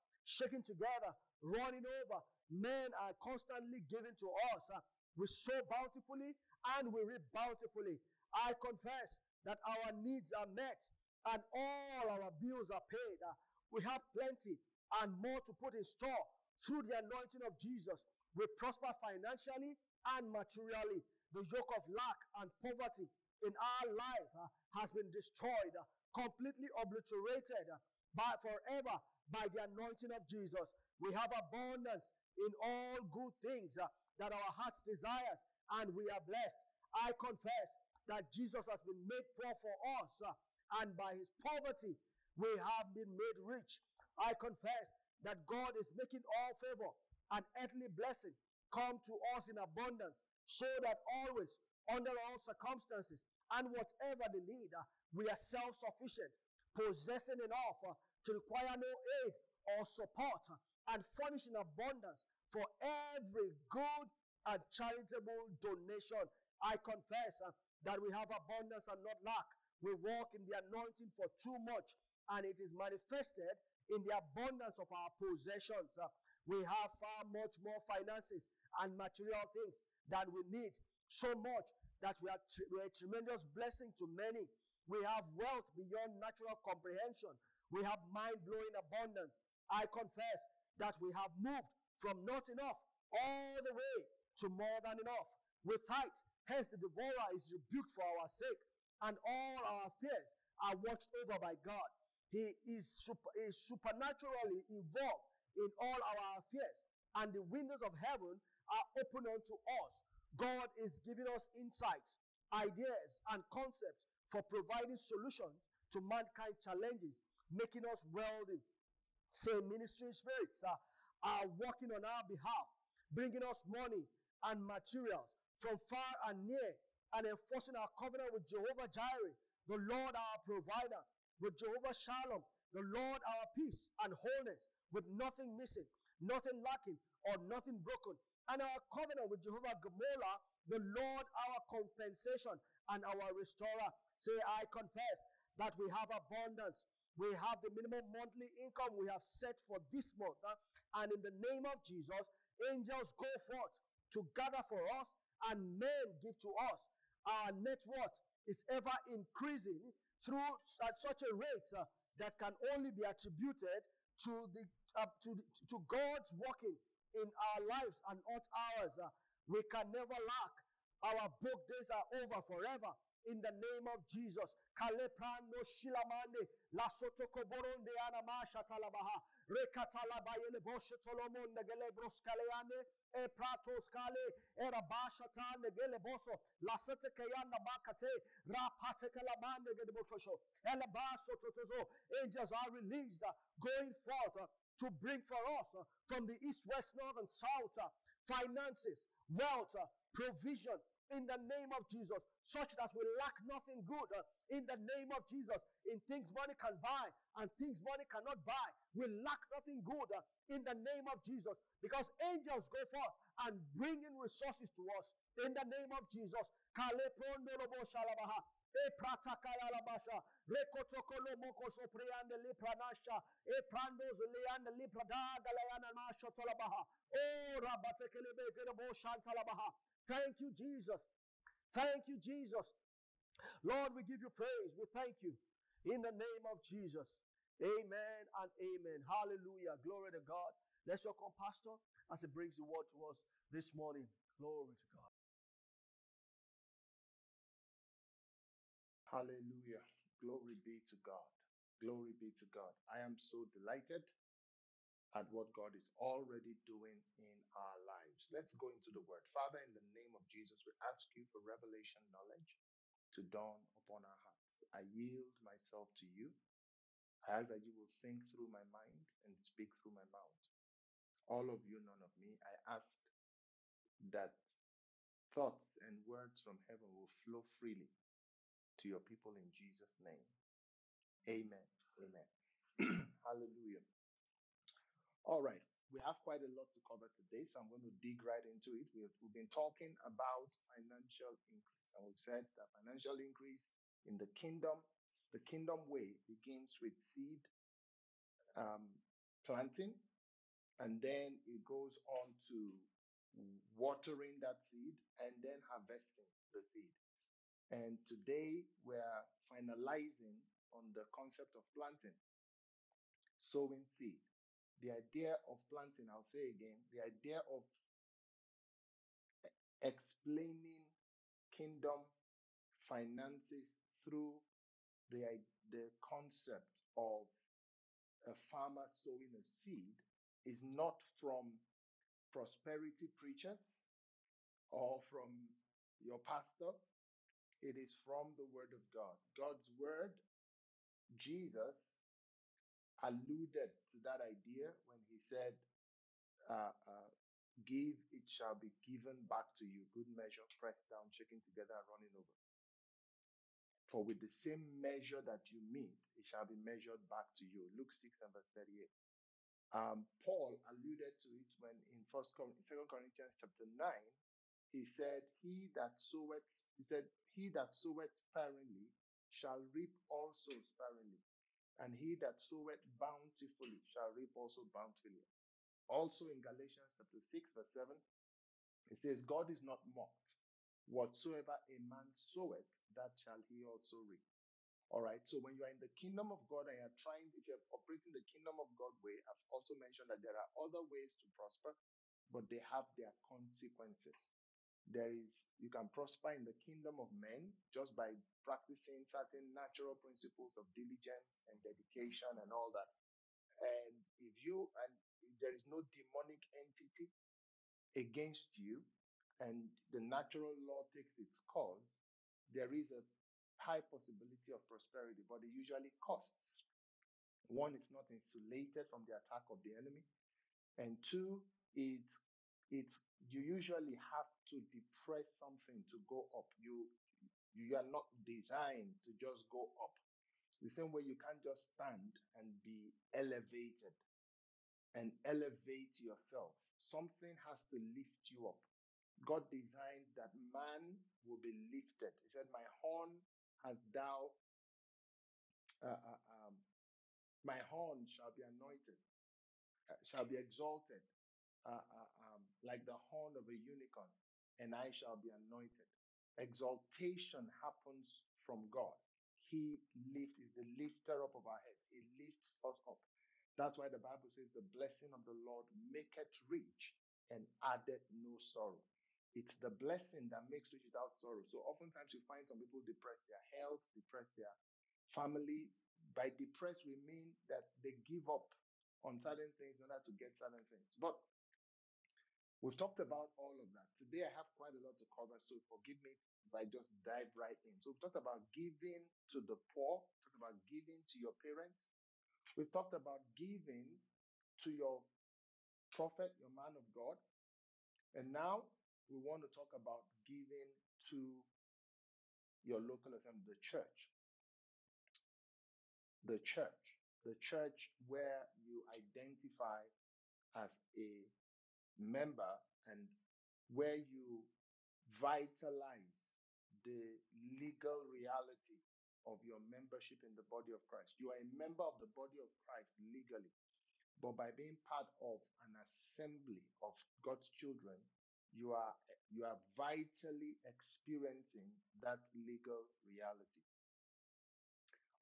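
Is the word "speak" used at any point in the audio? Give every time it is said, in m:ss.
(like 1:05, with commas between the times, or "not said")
4:29.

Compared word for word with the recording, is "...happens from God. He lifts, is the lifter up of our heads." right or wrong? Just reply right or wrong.
right.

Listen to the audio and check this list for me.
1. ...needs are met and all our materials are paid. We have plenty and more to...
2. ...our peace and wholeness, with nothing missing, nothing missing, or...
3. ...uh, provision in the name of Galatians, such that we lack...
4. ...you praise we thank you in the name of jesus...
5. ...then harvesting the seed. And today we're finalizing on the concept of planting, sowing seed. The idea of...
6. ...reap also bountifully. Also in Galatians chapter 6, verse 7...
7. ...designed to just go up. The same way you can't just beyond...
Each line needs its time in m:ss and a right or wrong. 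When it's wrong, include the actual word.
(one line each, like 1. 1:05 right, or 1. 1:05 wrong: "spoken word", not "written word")
1. 0:09 wrong: "bills", not "materials"
2. 2:13 wrong: "lacking", not "missing"
3. 3:19 wrong: "Jesus", not "Galatians"
4. 3:54 right
5. 5:05 right
6. 6:14 right
7. 7:08 wrong: "stand", not "beyond".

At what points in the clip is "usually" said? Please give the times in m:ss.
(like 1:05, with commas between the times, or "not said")
6:55, 7:03.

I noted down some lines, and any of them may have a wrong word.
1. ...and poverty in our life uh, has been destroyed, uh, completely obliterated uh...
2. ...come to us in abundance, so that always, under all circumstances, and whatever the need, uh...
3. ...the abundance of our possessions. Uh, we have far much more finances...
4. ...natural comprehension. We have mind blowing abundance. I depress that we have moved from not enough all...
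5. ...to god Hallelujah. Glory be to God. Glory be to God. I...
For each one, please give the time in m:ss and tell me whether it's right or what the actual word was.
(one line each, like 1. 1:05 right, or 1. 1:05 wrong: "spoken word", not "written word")
1. 0:22 right
2. 0:48 right
3. 1:14 right
4. 1:26 wrong: "confess", not "depress"
5. 4:04 right.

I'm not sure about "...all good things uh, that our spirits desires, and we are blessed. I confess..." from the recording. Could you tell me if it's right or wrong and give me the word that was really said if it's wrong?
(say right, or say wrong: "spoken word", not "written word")
wrong: "hearts", not "spirits".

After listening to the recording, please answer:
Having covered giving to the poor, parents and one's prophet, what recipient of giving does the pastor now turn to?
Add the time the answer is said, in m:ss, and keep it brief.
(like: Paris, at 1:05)
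local assembly, at 8:22.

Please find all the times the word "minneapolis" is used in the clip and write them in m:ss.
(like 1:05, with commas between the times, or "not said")
not said.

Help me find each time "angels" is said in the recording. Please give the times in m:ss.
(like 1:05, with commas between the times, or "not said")
2:32, 3:12, 3:32.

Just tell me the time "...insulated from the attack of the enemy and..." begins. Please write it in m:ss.
6:58.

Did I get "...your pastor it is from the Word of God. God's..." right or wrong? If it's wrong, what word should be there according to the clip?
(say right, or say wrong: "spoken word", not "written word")
right.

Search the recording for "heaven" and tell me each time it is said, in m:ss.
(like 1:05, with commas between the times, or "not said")
1:47, 4:36.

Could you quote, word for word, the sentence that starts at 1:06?
I confess uh, that we have abundance and not lack.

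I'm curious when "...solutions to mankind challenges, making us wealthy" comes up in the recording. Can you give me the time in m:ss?
1:54.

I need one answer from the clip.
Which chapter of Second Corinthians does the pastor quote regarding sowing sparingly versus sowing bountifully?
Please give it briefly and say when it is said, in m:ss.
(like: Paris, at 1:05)
chapter 9, at 6:03.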